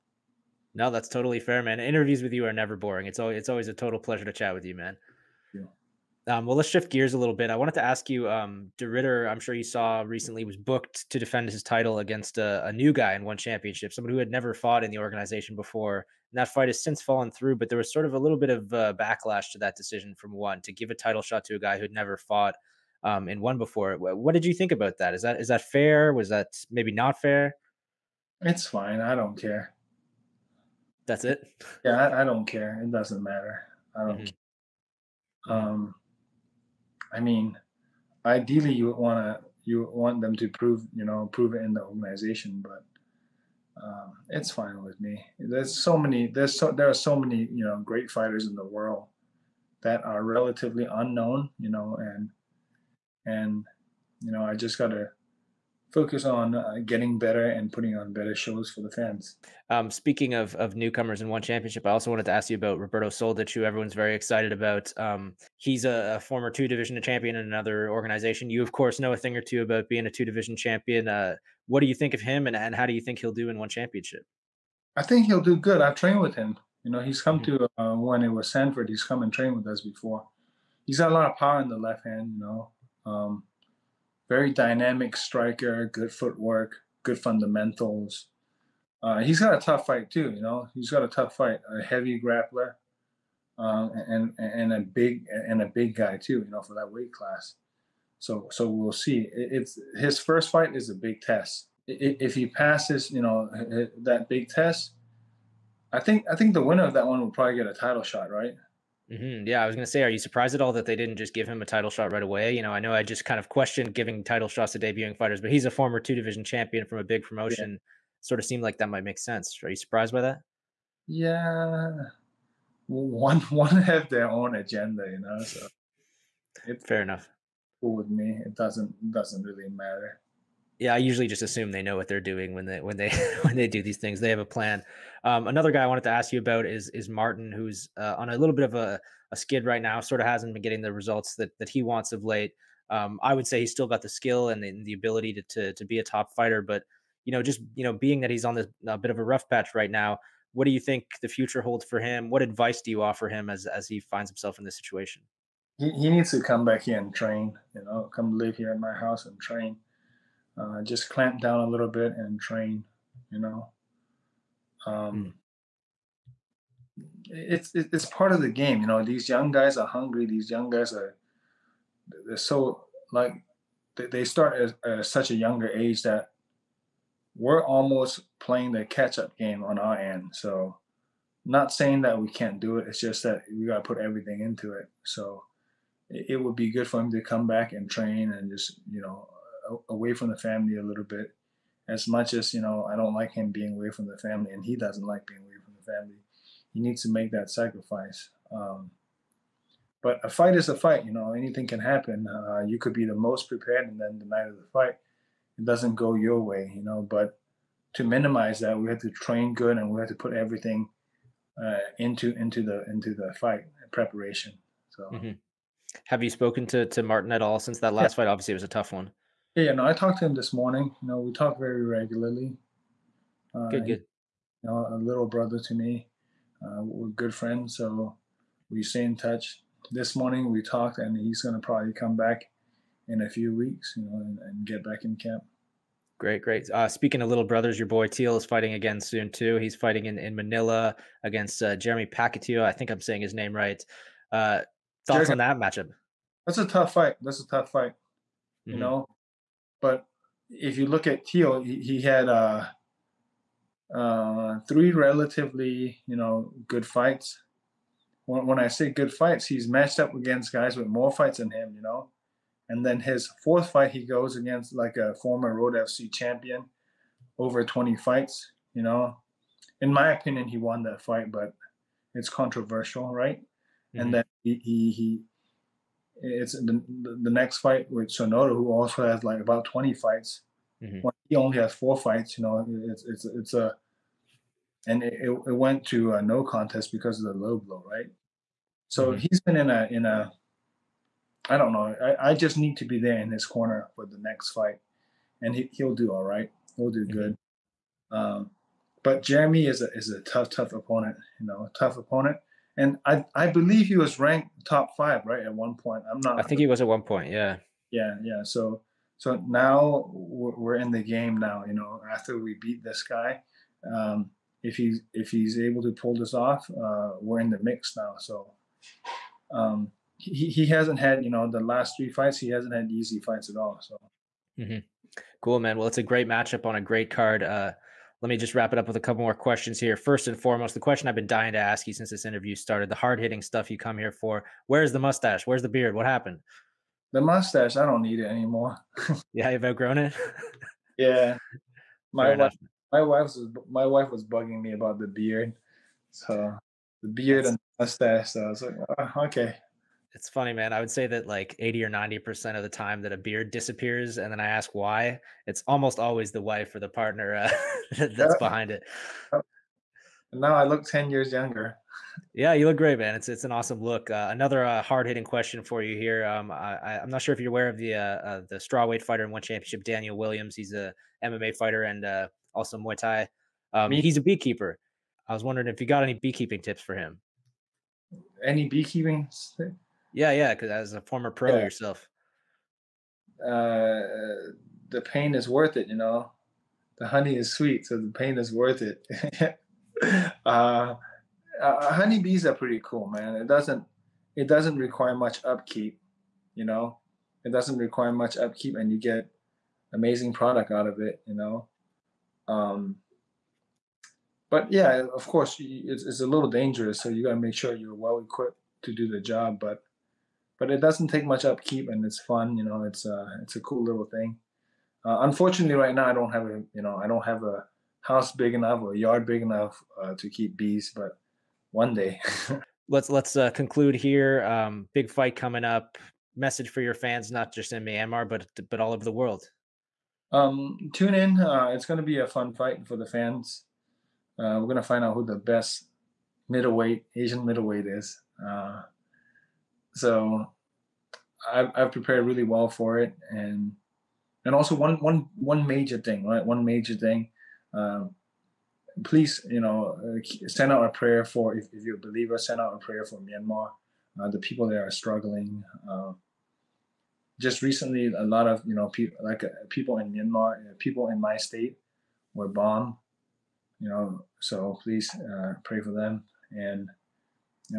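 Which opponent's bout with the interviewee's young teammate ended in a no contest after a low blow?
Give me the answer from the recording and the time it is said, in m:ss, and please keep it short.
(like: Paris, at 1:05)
Sonoda, at 4:38.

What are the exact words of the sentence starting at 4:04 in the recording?
Uh, thoughts Jeremy, on that matchup?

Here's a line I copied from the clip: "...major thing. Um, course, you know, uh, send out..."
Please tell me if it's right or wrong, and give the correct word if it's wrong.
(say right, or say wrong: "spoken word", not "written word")
wrong: "please", not "course".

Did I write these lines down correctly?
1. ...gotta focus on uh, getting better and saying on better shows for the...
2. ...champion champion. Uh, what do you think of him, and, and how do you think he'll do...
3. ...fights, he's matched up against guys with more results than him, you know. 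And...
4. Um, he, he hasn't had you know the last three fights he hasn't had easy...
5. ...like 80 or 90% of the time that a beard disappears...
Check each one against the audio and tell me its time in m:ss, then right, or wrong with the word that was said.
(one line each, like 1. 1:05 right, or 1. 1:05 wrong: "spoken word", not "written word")
1. 0:54 wrong: "putting", not "saying"
2. 1:10 wrong: "division", not "champion"
3. 4:19 wrong: "fights", not "results"
4. 5:19 right
5. 5:51 right.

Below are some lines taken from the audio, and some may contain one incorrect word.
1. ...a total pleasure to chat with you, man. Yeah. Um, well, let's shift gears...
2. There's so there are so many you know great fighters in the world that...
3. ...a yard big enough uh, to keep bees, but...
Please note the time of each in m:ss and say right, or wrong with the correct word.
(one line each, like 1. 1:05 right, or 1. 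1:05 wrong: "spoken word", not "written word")
1. 0:03 right
2. 0:46 right
3. 6:58 right.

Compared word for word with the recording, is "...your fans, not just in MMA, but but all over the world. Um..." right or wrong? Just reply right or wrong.
wrong.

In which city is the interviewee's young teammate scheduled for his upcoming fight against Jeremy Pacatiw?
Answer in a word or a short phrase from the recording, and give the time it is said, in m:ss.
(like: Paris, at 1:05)
Manila, at 4:00.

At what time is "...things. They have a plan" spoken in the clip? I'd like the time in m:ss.
2:13.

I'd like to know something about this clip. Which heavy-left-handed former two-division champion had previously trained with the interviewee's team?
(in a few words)
Roberto Soldić.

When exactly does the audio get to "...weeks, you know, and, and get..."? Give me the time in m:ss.
3:53.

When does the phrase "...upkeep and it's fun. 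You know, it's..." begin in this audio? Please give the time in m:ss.
6:51.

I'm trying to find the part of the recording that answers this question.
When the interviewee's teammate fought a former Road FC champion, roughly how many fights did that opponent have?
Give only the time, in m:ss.
4:27.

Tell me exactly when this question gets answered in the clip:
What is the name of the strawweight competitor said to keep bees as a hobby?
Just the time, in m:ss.
6:09.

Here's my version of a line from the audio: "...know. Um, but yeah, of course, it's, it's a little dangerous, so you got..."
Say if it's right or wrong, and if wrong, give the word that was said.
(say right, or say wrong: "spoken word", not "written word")
right.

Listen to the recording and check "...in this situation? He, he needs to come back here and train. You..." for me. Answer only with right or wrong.
right.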